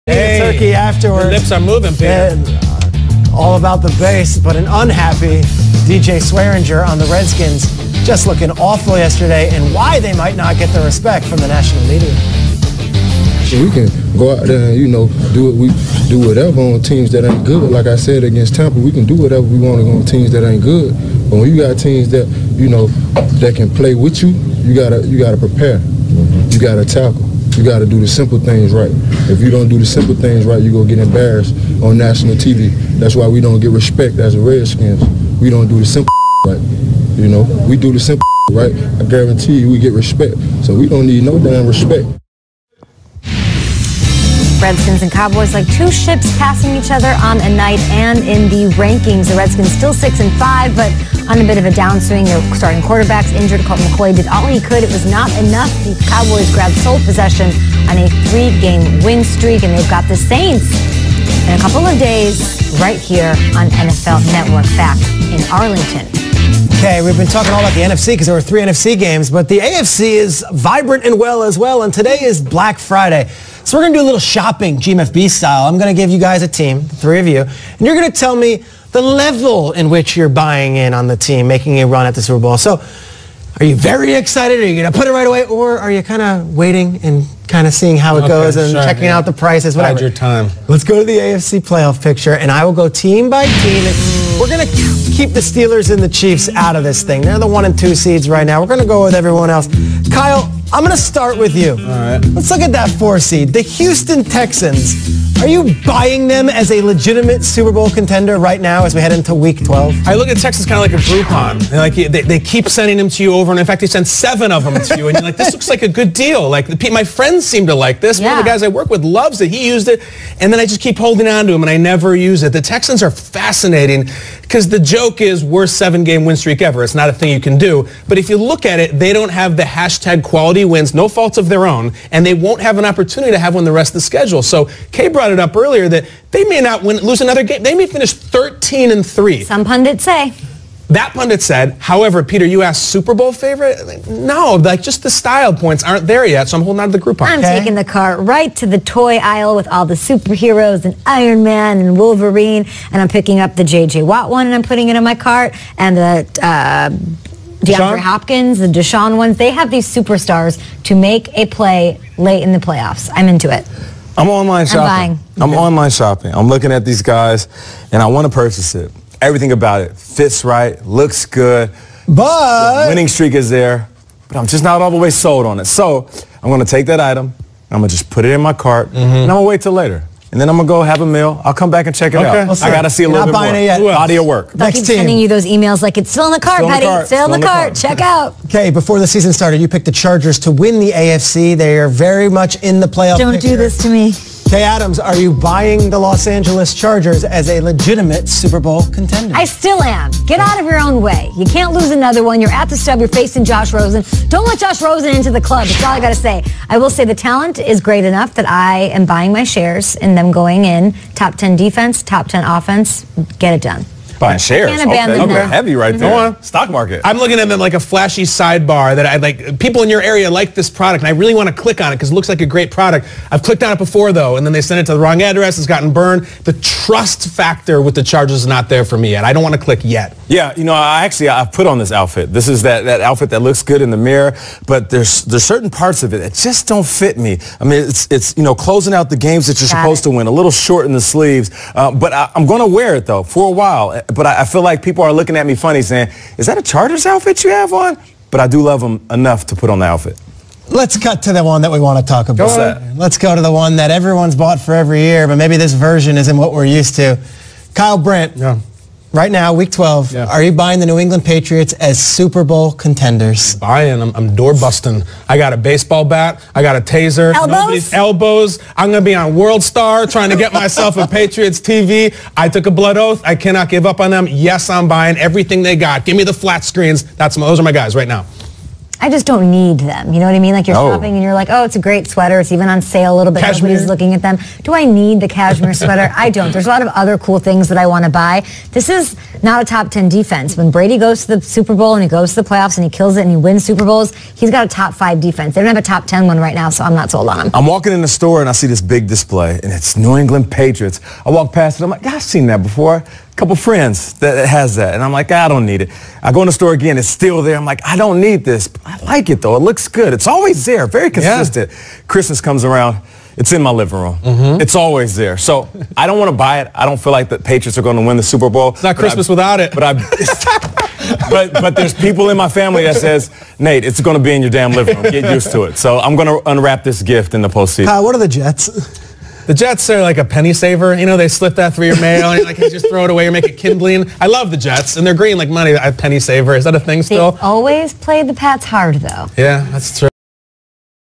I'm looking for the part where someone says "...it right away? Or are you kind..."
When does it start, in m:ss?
1:25.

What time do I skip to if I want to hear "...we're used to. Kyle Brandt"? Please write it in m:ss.
4:16.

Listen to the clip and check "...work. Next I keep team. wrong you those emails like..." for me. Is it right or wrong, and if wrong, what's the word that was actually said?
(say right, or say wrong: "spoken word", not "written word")
wrong: "sending", not "wrong".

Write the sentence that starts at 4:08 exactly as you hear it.
But I do love them enough to put on the outfit.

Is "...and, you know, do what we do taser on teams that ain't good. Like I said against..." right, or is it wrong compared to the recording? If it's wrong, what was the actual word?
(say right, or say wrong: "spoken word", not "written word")
wrong: "whatever", not "taser".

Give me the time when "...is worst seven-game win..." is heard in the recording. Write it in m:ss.
2:05.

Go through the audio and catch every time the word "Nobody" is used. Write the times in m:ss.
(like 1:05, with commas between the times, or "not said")
4:27, 4:43.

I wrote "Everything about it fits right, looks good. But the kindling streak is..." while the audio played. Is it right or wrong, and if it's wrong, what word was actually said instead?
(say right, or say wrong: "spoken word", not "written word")
wrong: "winning", not "kindling".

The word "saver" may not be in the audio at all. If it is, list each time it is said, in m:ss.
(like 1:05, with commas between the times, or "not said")
5:30, 5:36.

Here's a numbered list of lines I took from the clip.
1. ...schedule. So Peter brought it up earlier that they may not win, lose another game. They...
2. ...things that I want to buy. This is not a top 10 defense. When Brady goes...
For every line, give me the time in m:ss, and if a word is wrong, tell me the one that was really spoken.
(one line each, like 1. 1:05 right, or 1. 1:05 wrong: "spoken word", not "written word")
1. 2:14 wrong: "Kay", not "Peter"
2. 4:47 right.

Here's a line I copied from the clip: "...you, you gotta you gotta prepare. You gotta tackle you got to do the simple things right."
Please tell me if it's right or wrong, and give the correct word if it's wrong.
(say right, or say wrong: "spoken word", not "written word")
right.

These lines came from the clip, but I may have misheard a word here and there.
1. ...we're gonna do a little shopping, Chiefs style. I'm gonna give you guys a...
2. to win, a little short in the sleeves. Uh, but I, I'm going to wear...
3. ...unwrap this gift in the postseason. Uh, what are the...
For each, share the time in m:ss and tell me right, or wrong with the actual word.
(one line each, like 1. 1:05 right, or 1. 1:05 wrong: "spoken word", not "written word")
1. 1:13 wrong: "GMFB", not "Chiefs"
2. 4:00 right
3. 5:26 right.